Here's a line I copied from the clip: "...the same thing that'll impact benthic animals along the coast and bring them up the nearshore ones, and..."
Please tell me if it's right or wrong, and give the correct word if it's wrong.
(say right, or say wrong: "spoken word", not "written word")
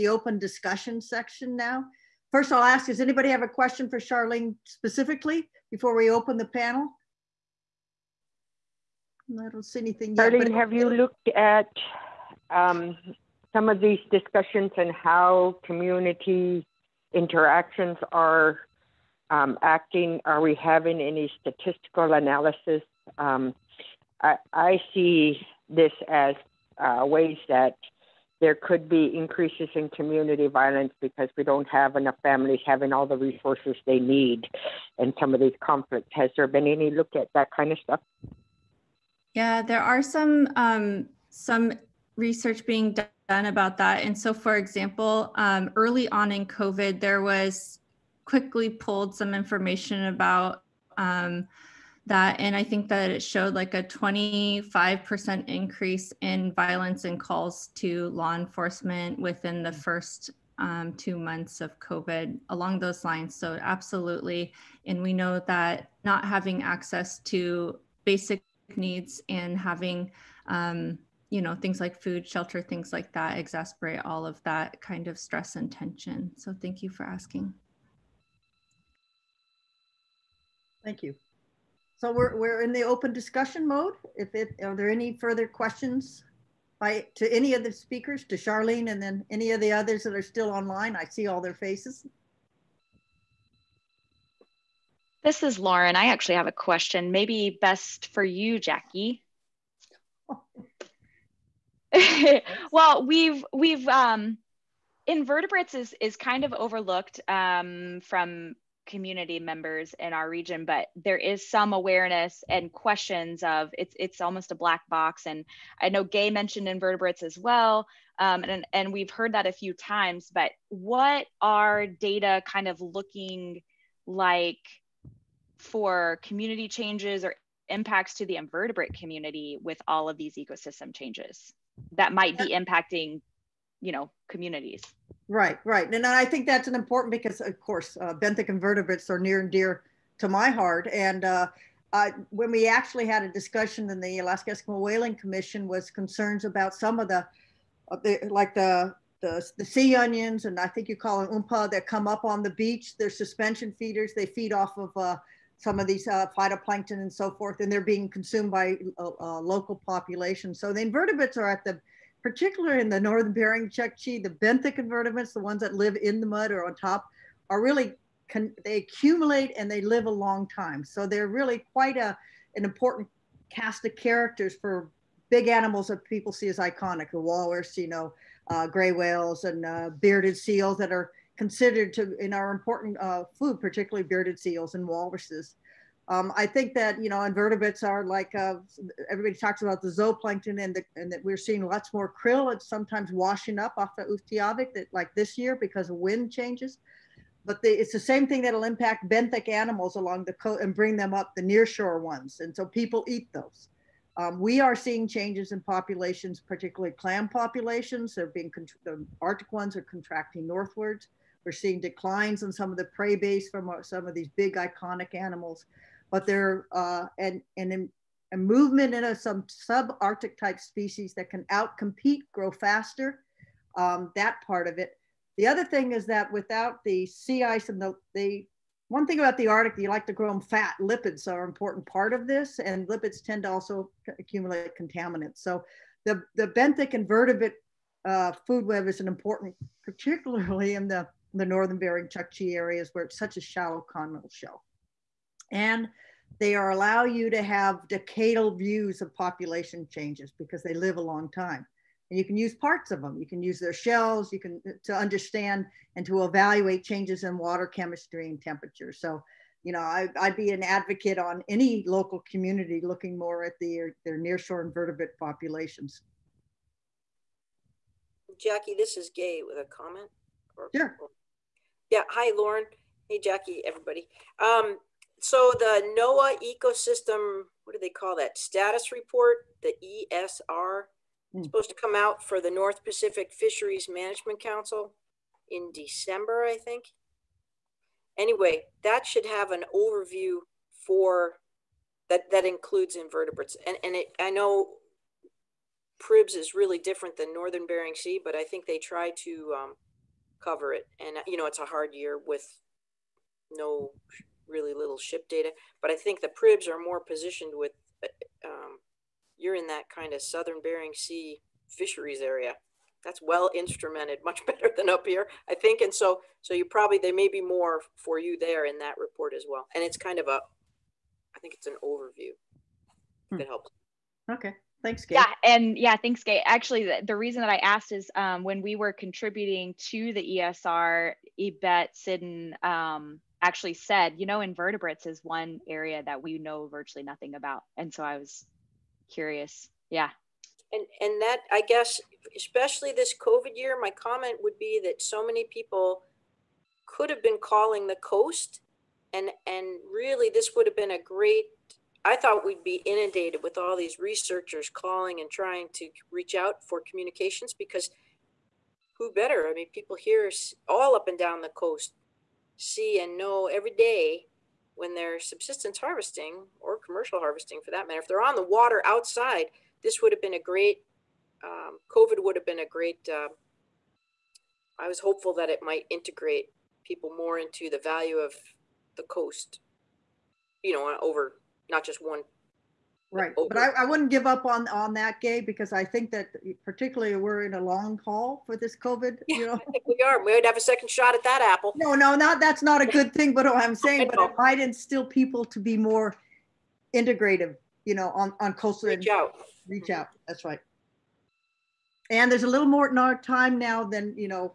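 right.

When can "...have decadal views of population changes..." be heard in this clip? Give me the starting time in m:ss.
4:07.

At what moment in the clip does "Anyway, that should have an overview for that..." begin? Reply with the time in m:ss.
4:48.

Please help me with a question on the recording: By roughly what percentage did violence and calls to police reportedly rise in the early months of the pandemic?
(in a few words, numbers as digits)
25%.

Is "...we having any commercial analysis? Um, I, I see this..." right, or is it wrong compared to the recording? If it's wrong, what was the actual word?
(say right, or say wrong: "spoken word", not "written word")
wrong: "statistical", not "commercial".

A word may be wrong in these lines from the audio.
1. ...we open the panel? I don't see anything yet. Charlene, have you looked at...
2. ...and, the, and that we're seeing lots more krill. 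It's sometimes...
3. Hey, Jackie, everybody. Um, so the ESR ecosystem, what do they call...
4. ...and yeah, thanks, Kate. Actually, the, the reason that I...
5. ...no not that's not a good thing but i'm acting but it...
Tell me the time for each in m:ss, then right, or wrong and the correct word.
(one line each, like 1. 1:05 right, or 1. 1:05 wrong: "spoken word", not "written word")
1. 0:05 right
2. 3:10 right
3. 4:33 wrong: "NOAA", not "ESR"
4. 5:25 right
5. 6:31 wrong: "saying", not "acting".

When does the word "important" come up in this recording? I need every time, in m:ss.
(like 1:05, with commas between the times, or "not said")
2:16, 2:52, 3:02, 3:51, 3:59.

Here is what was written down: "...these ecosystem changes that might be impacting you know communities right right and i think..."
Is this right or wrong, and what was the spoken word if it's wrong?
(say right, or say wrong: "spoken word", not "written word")
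right.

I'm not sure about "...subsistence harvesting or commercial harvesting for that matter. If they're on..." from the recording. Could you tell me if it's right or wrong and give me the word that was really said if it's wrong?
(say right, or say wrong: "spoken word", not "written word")
right.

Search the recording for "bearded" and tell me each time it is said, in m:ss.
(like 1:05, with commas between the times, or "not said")
3:00, 3:04.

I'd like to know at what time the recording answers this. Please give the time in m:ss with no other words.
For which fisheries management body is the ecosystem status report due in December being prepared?
4:42.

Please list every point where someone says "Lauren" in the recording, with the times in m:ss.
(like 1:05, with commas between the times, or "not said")
1:35, 4:32.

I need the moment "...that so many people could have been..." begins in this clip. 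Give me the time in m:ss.
5:44.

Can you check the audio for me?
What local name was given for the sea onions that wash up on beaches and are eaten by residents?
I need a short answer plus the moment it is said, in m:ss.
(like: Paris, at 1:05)
umpa, at 2:31.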